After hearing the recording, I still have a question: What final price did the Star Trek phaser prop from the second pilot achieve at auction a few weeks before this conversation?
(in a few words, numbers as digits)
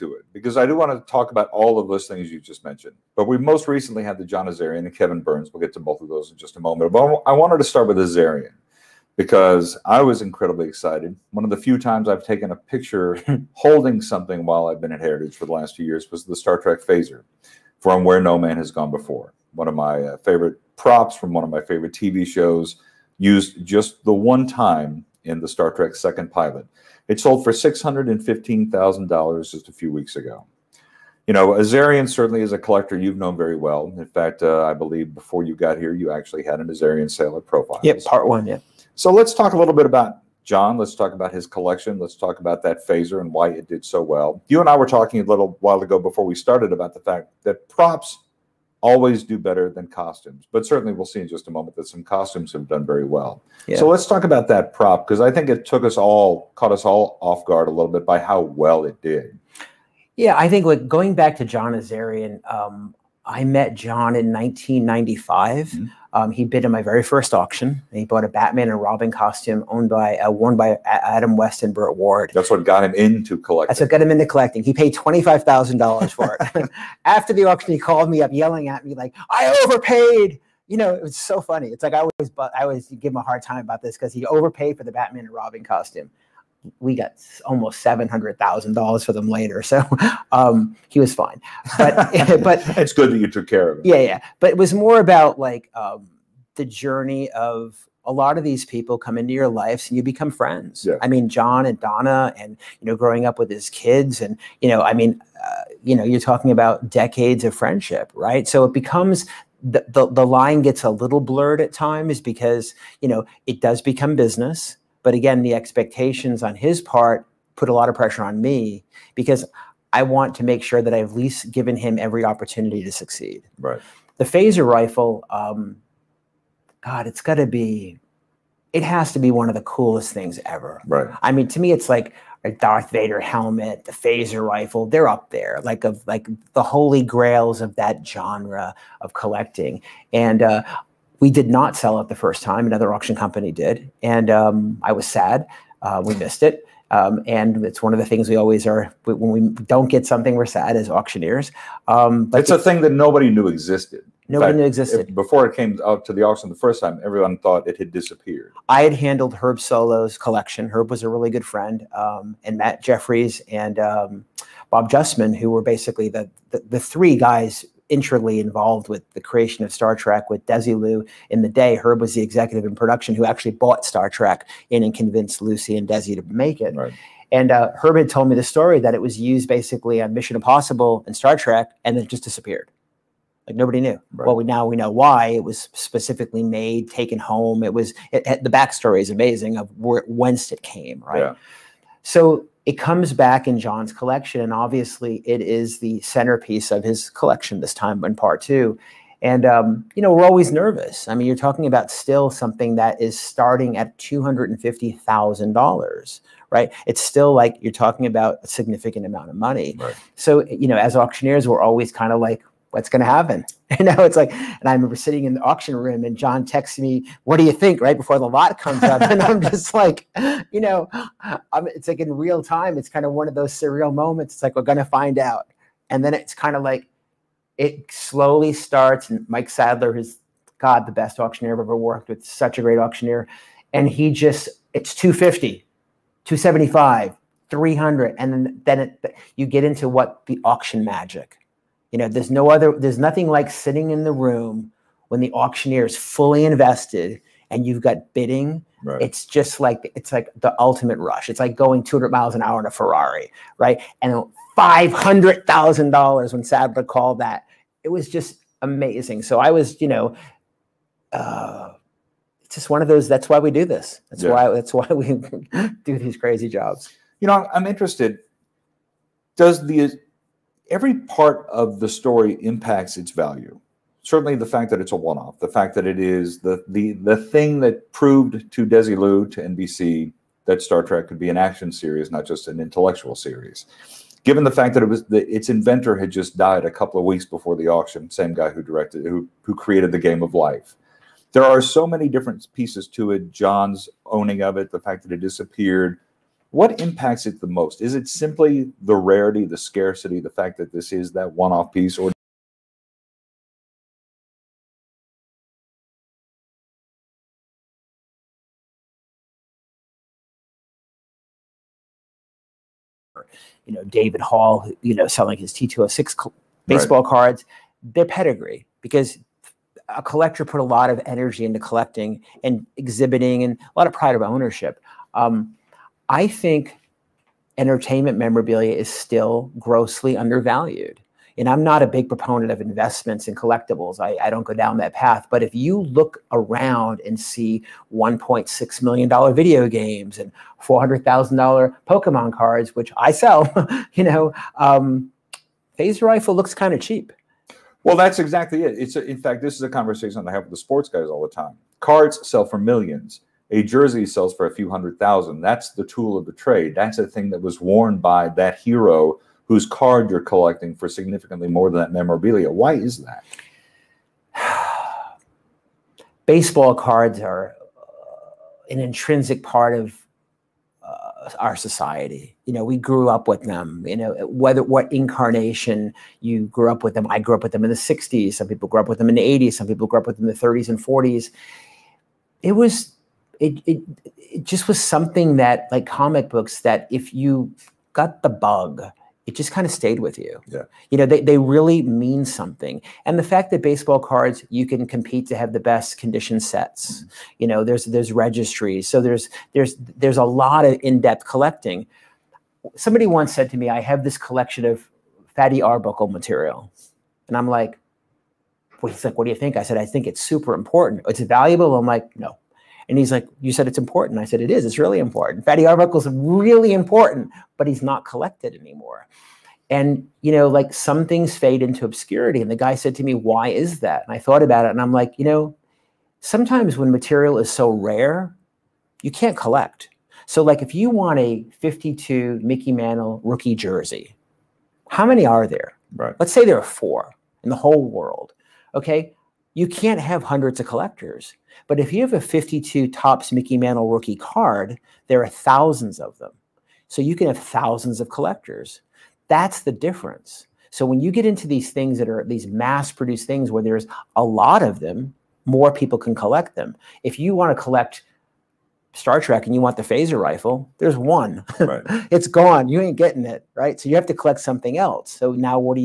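$615,000.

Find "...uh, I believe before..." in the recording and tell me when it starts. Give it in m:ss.
0:34.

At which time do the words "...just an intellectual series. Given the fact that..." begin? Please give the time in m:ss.
4:42.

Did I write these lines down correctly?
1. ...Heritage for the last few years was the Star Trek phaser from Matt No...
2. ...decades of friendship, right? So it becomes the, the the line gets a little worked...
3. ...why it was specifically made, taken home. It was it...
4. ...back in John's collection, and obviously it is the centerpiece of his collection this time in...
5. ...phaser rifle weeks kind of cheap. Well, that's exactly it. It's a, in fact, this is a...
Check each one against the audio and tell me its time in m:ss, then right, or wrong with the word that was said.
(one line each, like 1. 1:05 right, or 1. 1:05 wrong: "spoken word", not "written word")
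1. 0:14 wrong: "Where", not "Matt"
2. 1:46 wrong: "blurred", not "worked"
3. 3:04 right
4. 3:13 right
5. 5:45 wrong: "looks", not "weeks".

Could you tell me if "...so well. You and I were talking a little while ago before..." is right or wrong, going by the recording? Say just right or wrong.
right.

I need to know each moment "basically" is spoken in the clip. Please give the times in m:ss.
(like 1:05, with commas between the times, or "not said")
2:45, 2:59.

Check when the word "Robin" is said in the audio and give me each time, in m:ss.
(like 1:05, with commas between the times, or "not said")
1:08, 1:25.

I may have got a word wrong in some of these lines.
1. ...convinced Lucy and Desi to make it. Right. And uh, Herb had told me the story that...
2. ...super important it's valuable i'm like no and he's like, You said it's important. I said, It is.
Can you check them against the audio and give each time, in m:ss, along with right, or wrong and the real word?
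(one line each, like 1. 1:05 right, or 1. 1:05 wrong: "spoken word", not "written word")
1. 2:54 right
2. 6:50 right.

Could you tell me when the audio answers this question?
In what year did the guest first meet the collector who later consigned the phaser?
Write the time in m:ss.
1:04.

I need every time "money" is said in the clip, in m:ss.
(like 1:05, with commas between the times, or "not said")
3:29.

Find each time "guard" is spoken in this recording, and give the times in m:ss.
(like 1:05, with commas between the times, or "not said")
0:57.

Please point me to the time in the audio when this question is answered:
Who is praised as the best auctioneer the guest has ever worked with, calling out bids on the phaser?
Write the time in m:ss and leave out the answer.
3:49.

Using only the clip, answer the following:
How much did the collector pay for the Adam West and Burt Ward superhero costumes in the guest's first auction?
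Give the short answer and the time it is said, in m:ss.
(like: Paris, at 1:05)
$25,000, at 1:14.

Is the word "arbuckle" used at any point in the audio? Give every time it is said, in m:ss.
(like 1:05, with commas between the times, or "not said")
6:45, 6:55.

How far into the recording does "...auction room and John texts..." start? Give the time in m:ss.
3:35.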